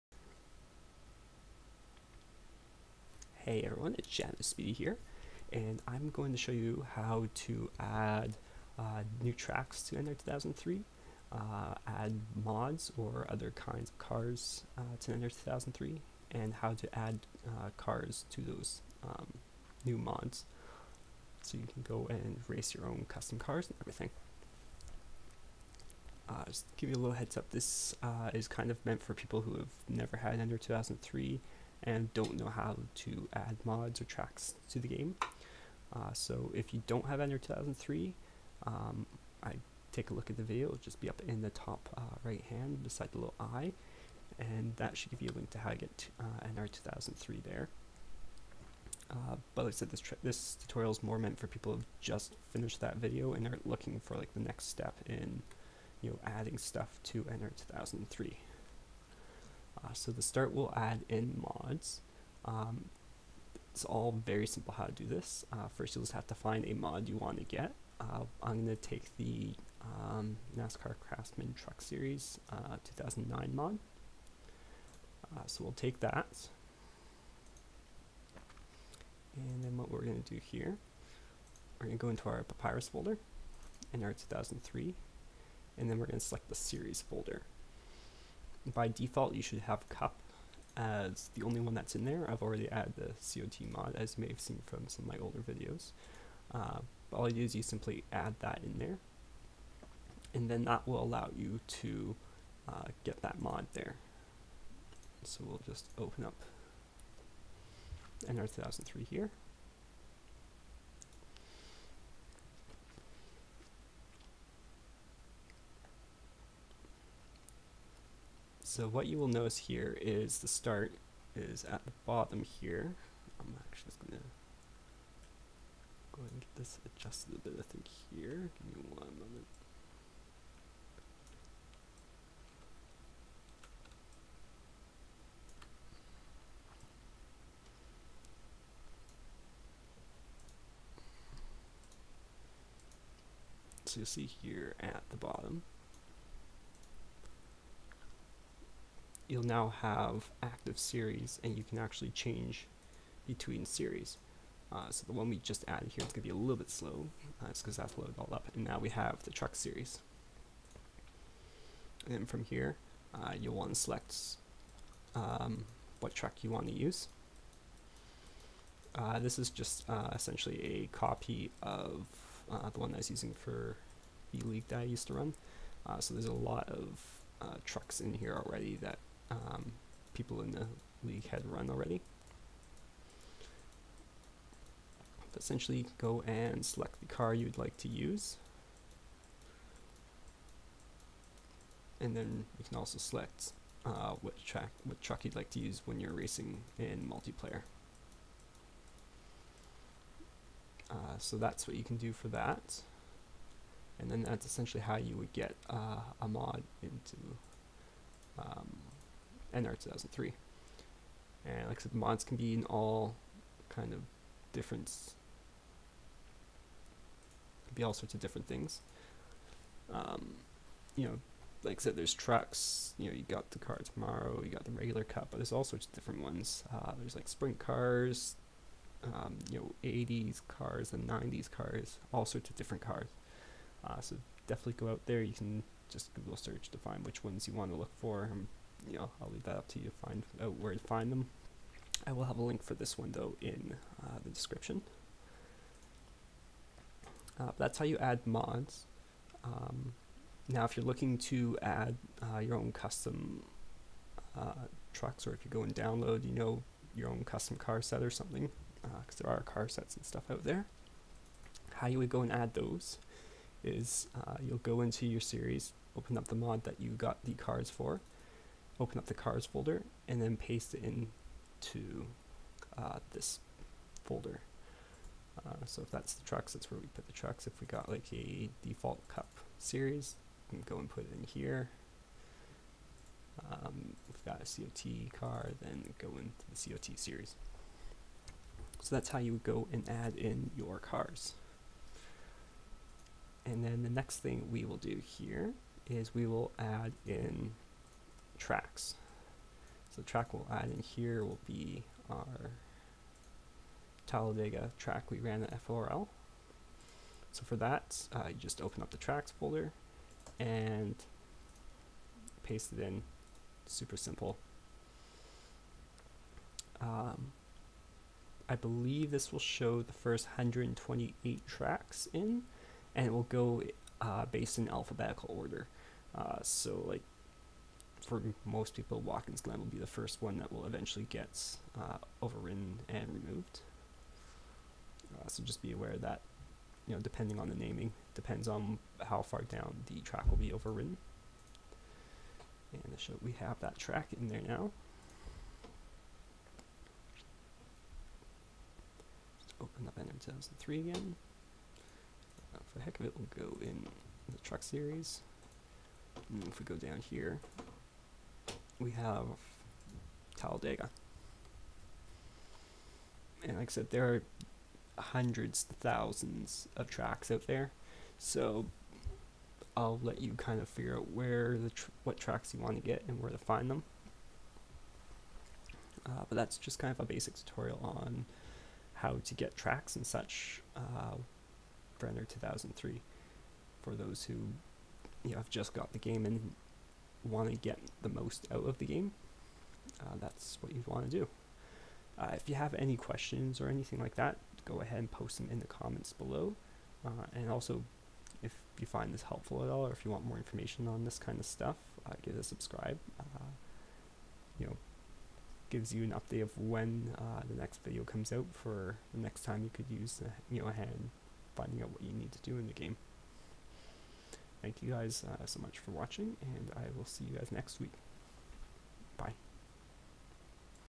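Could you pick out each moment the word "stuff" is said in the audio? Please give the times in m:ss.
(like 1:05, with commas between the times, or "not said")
0:56, 4:20, 6:41.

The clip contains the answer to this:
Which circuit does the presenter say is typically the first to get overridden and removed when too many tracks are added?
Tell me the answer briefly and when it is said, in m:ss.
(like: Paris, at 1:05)
Watkins Glen, at 5:29.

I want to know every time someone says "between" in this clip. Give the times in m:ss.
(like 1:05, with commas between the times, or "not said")
2:33.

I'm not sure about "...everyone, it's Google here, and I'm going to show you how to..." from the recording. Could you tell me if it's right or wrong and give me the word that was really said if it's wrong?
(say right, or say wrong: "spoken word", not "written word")
wrong: "Shadowspeedy", not "Google".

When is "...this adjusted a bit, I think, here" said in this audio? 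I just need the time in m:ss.
2:06.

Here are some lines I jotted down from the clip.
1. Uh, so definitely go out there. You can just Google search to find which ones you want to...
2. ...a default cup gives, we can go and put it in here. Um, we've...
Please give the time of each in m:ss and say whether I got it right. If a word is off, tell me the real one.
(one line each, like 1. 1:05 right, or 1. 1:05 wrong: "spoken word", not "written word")
1. 3:53 right
2. 4:38 wrong: "series", not "gives".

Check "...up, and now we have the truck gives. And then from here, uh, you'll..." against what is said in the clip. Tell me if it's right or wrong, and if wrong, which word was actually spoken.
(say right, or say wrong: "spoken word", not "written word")
wrong: "series", not "gives".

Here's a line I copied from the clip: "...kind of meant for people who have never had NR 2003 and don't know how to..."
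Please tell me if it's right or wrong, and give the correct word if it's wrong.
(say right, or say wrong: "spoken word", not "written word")
right.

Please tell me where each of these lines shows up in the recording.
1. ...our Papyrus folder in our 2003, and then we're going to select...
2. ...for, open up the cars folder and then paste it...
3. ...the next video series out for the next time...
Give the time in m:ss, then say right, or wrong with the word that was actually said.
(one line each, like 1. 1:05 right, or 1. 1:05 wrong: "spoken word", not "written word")
1. 1:22 right
2. 4:27 right
3. 6:47 wrong: "comes", not "series".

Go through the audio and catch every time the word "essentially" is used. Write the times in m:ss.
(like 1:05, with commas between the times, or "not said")
2:50, 3:05, 3:24.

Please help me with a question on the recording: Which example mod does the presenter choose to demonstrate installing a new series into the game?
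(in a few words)
NASCAR Craftsman Truck Series 2009.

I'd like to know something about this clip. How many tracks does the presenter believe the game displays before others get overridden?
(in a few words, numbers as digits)
128.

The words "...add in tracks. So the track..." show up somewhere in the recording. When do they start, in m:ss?
4:56.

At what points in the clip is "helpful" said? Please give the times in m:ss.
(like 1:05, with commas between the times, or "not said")
6:39.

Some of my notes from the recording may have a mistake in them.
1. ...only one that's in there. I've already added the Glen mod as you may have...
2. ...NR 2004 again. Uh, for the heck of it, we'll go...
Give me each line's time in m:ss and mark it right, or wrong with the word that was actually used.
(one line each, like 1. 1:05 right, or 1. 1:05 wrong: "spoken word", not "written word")
1. 1:31 wrong: "COT", not "Glen"
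2. 5:49 wrong: "2003", not "2004".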